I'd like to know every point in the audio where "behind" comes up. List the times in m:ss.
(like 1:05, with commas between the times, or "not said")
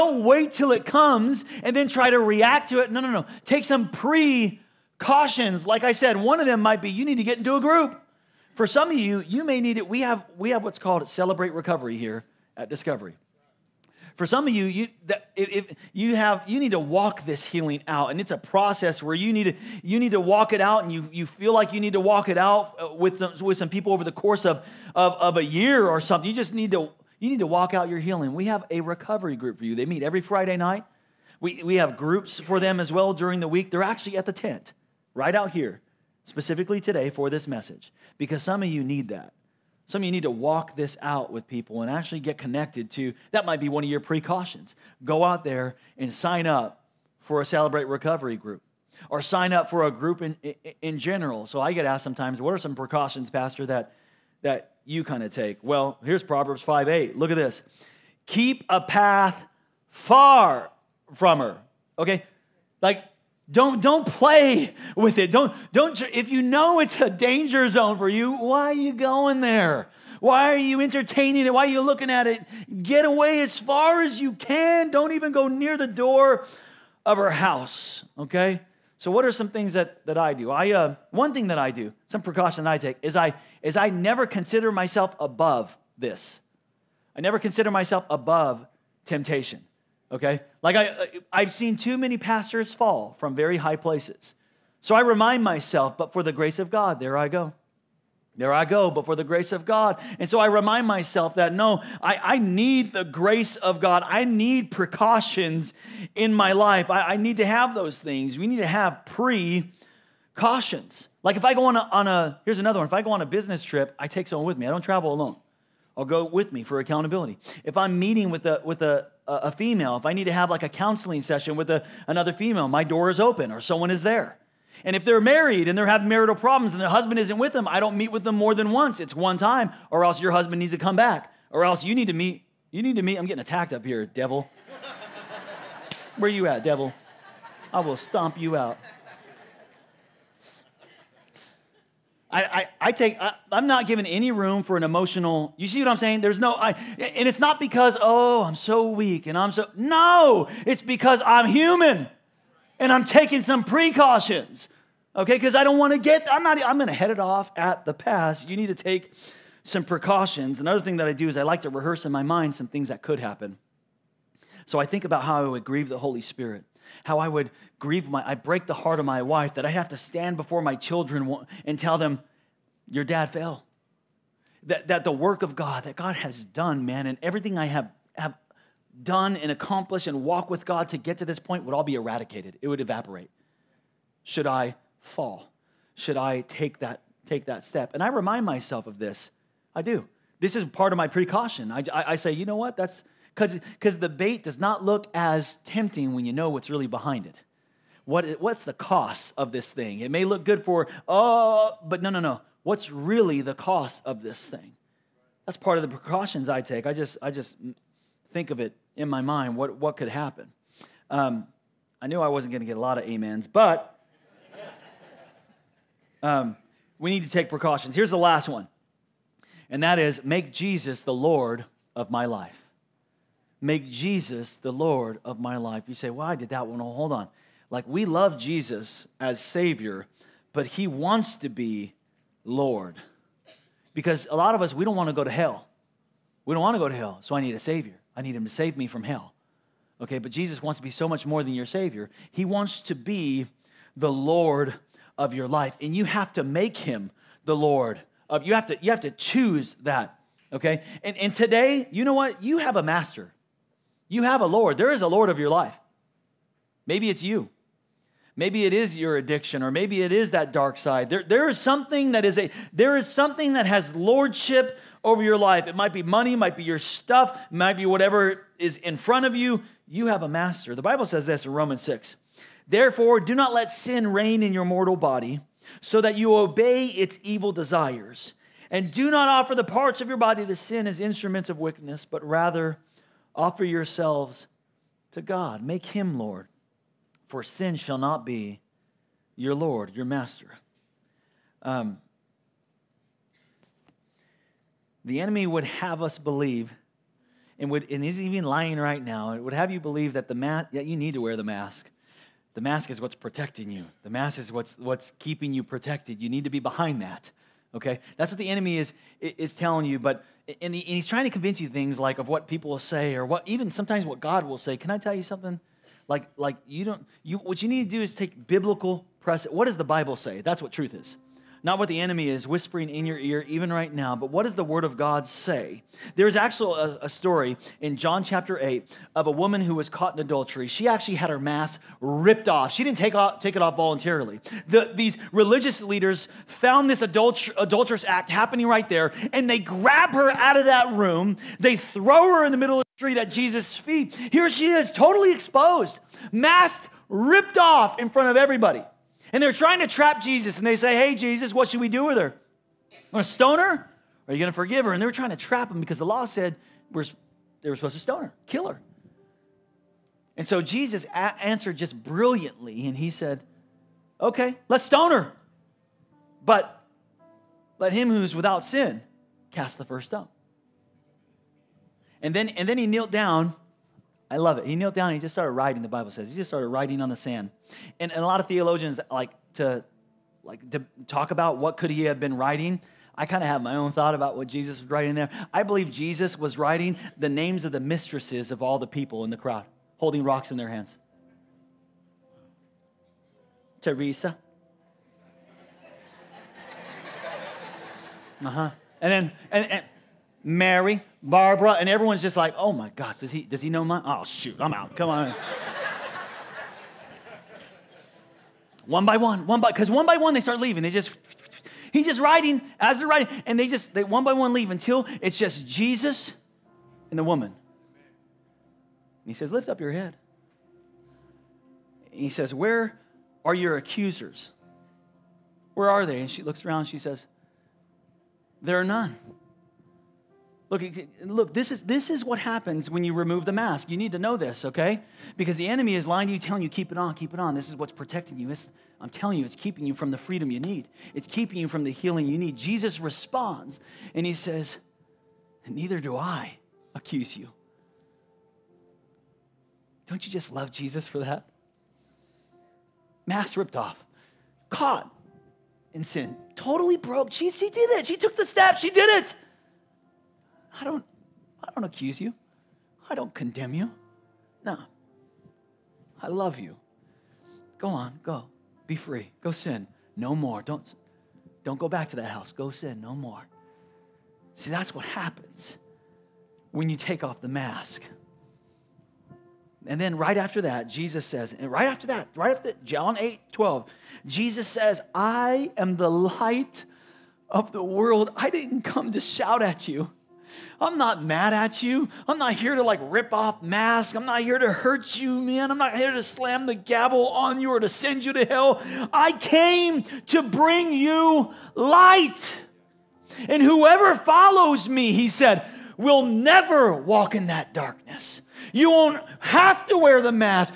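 3:16, 5:06.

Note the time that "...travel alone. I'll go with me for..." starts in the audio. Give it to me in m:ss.
1:54.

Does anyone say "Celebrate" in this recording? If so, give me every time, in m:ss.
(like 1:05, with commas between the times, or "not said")
0:11, 0:47.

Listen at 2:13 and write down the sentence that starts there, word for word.
I'm getting attacked up here, devil.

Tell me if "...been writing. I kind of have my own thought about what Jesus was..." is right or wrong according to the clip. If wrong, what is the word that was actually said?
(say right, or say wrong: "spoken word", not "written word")
right.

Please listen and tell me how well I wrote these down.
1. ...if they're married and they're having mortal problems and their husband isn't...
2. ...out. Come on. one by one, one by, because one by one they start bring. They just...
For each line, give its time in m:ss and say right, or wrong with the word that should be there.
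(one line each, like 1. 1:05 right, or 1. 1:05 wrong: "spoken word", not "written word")
1. 2:04 wrong: "marital", not "mortal"
2. 6:44 wrong: "leaving", not "bring".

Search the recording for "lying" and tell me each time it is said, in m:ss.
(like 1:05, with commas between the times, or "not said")
4:58, 7:16.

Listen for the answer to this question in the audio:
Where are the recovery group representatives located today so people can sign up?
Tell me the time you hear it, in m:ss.
0:34.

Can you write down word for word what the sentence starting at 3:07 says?
And I remind myself of this.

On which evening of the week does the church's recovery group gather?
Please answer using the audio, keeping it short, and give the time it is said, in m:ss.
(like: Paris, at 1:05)
Friday, at 0:30.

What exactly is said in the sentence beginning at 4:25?
It might be money, might be your stuff, might be whatever is in front of you.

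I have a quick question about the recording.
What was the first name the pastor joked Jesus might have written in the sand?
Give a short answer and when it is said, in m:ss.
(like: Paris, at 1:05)
Teresa, at 6:33.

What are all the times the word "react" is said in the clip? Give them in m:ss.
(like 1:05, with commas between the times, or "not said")
0:02.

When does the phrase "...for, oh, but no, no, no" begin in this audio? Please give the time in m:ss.
3:20.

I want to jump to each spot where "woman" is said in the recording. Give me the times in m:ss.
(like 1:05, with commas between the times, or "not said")
5:29, 6:57.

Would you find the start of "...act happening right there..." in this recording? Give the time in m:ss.
5:38.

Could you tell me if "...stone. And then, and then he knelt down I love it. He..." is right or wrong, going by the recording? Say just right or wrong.
right.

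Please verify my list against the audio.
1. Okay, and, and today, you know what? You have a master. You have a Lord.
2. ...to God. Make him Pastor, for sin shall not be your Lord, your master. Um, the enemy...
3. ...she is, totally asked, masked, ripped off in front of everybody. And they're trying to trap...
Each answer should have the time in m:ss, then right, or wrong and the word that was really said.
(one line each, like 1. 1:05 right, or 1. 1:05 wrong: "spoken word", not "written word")
1. 4:10 right
2. 4:45 wrong: "Lord", not "Pastor"
3. 5:44 wrong: "exposed", not "asked".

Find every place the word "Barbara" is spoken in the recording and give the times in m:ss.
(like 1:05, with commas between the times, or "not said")
6:41.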